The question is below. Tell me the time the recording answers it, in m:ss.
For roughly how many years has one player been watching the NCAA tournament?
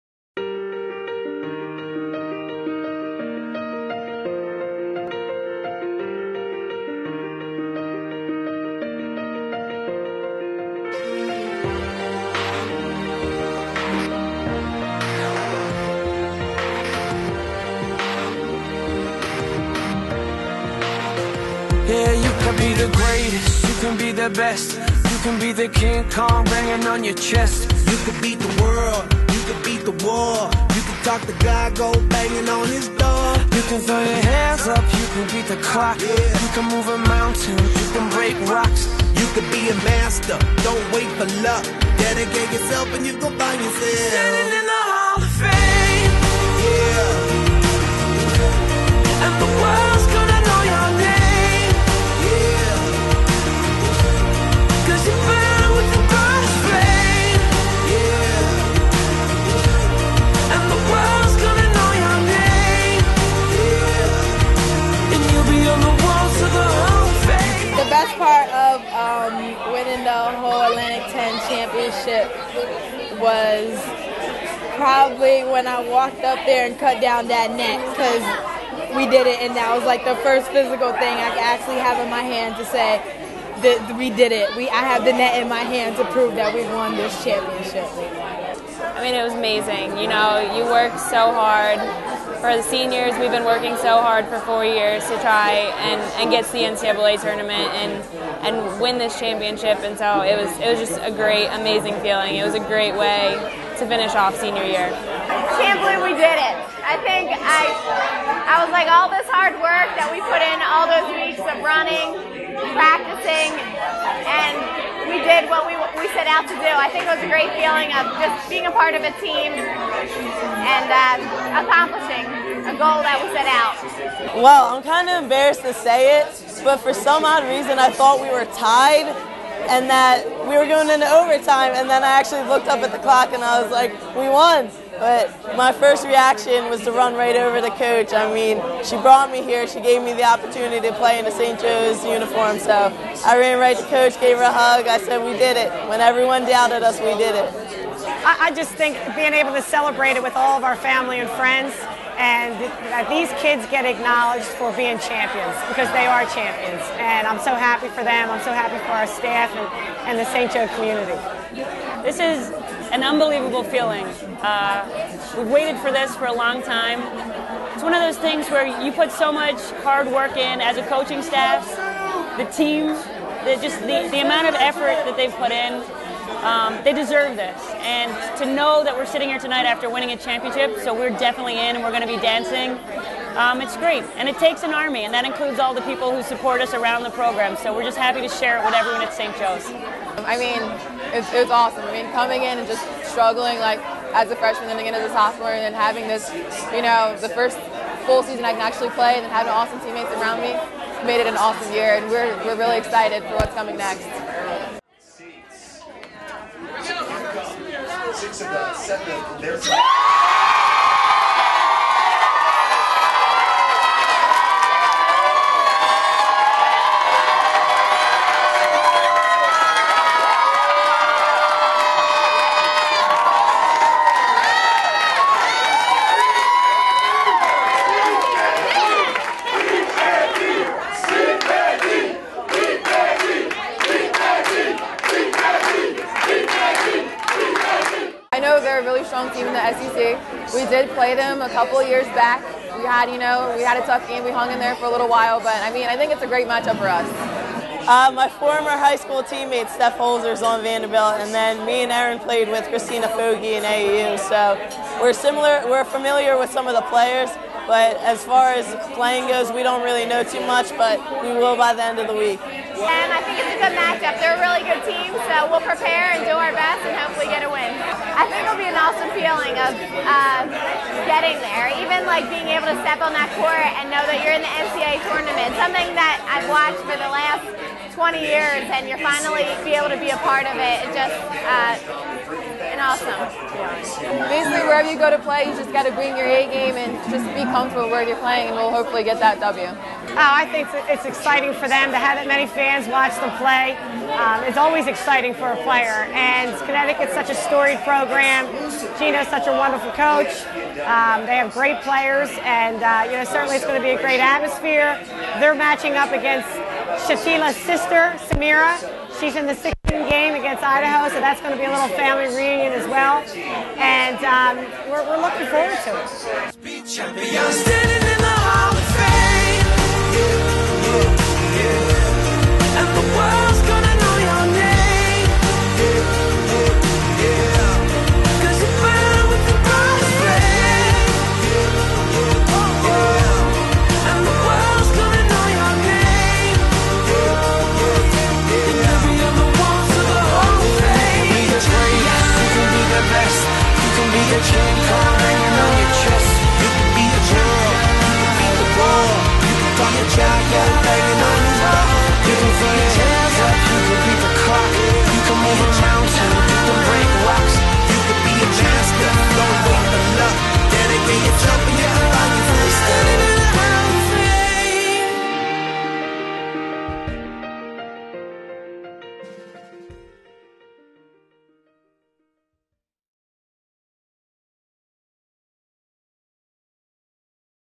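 4:37.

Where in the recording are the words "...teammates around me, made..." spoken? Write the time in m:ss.
3:19.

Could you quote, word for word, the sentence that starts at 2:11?
And then I actually looked up at the clock and I was like, we won.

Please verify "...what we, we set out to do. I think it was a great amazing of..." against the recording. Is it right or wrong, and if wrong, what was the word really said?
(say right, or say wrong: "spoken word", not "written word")
wrong: "feeling", not "amazing".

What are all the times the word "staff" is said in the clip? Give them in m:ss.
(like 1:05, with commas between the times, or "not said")
2:39, 2:51.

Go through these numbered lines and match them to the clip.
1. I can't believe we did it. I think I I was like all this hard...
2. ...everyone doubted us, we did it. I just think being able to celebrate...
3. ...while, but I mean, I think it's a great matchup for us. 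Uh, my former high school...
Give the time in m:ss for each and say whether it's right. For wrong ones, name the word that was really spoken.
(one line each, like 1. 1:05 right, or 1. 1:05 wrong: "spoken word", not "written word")
1. 1:44 right
2. 2:26 right
3. 4:05 right.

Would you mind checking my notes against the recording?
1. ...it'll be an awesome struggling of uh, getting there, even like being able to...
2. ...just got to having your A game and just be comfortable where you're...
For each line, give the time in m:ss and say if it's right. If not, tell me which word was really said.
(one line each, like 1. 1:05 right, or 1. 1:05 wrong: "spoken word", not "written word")
1. 4:28 wrong: "feeling", not "struggling"
2. 4:45 wrong: "bring", not "having".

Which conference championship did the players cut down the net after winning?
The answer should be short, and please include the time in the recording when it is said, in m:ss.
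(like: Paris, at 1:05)
Atlantic 10, at 1:10.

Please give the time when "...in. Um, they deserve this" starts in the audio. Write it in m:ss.
2:55.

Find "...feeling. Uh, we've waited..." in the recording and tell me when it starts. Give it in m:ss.
2:43.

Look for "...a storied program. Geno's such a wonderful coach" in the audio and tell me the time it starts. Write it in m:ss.
4:57.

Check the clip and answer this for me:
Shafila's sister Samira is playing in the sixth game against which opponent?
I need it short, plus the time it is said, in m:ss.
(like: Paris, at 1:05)
Idaho, at 5:10.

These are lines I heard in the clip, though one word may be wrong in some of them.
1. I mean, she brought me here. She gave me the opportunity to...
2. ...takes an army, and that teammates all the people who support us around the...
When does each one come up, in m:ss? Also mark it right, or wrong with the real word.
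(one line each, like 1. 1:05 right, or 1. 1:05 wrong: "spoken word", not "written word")
1. 2:18 right
2. 3:04 wrong: "includes", not "teammates".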